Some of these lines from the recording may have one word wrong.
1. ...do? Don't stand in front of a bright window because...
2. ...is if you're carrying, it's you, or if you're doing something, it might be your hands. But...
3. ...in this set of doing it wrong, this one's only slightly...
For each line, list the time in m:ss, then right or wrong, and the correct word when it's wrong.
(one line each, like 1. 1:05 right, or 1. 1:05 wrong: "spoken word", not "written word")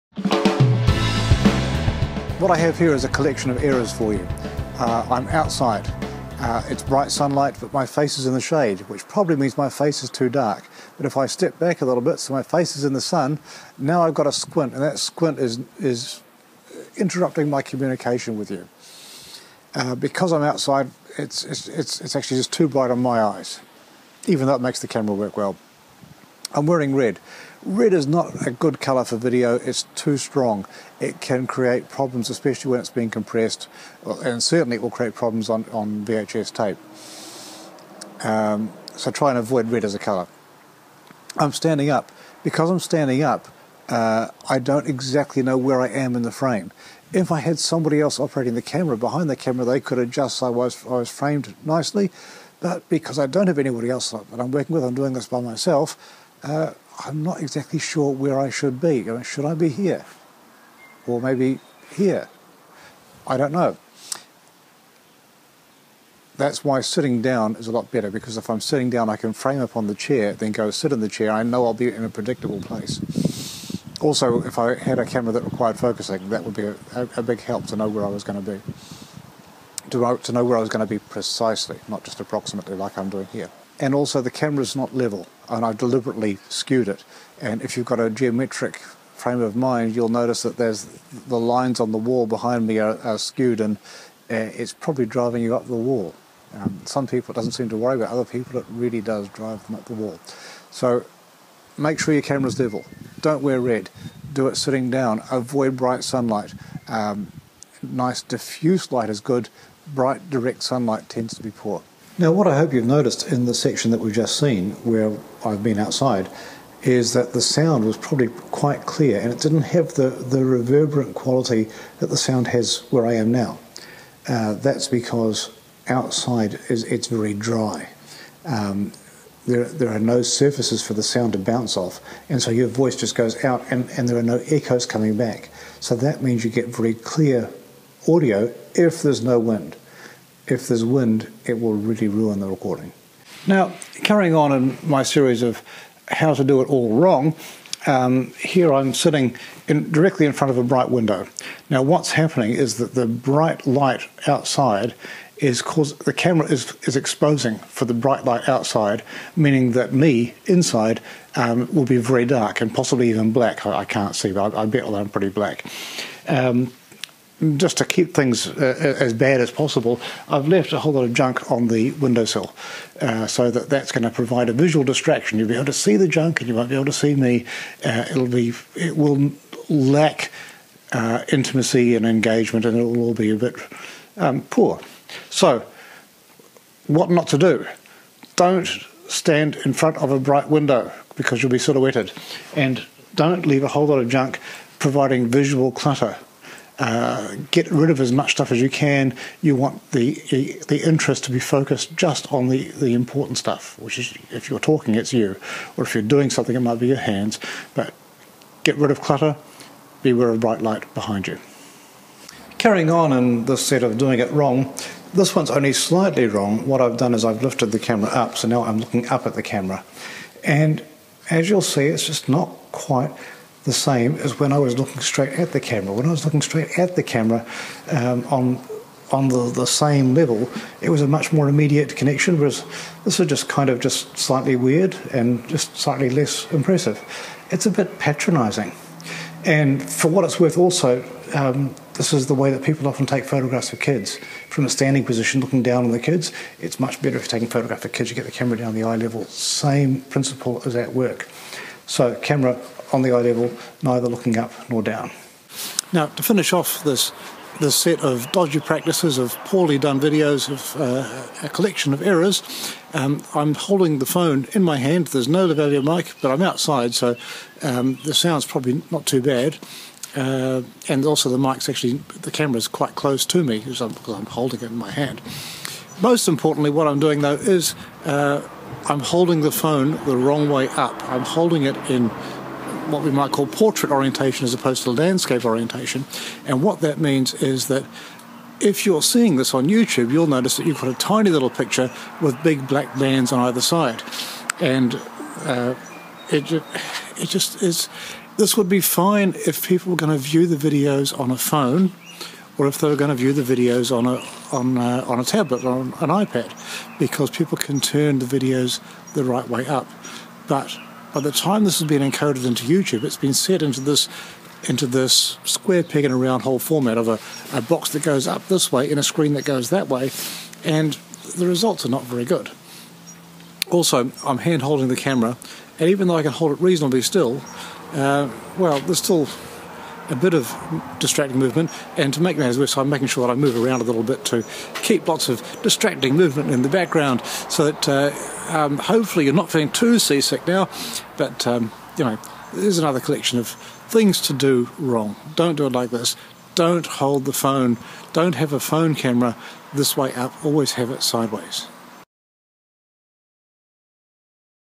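1. 3:07 right
2. 3:23 wrong: "talking", not "carrying"
3. 3:33 right.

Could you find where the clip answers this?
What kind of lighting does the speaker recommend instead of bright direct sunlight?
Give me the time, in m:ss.
1:47.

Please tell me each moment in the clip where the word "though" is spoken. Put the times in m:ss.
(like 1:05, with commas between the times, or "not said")
0:24, 4:37, 5:26.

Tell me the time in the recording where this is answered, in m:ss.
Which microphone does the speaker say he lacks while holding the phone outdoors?
4:25.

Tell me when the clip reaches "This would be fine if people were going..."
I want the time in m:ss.
4:58.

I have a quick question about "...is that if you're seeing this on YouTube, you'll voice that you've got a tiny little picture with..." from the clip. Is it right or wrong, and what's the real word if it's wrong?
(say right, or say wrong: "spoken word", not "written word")
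wrong: "notice", not "voice".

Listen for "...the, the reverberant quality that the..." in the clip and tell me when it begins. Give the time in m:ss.
1:59.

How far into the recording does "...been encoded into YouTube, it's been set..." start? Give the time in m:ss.
5:11.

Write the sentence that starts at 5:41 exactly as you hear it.
But um, you know, there's another collection of things to do wrong.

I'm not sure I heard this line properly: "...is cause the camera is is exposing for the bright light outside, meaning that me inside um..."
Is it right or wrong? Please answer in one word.
right.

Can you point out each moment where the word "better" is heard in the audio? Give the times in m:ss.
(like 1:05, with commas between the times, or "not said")
1:07, 4:07.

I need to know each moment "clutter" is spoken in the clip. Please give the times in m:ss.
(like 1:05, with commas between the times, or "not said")
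3:15, 3:28.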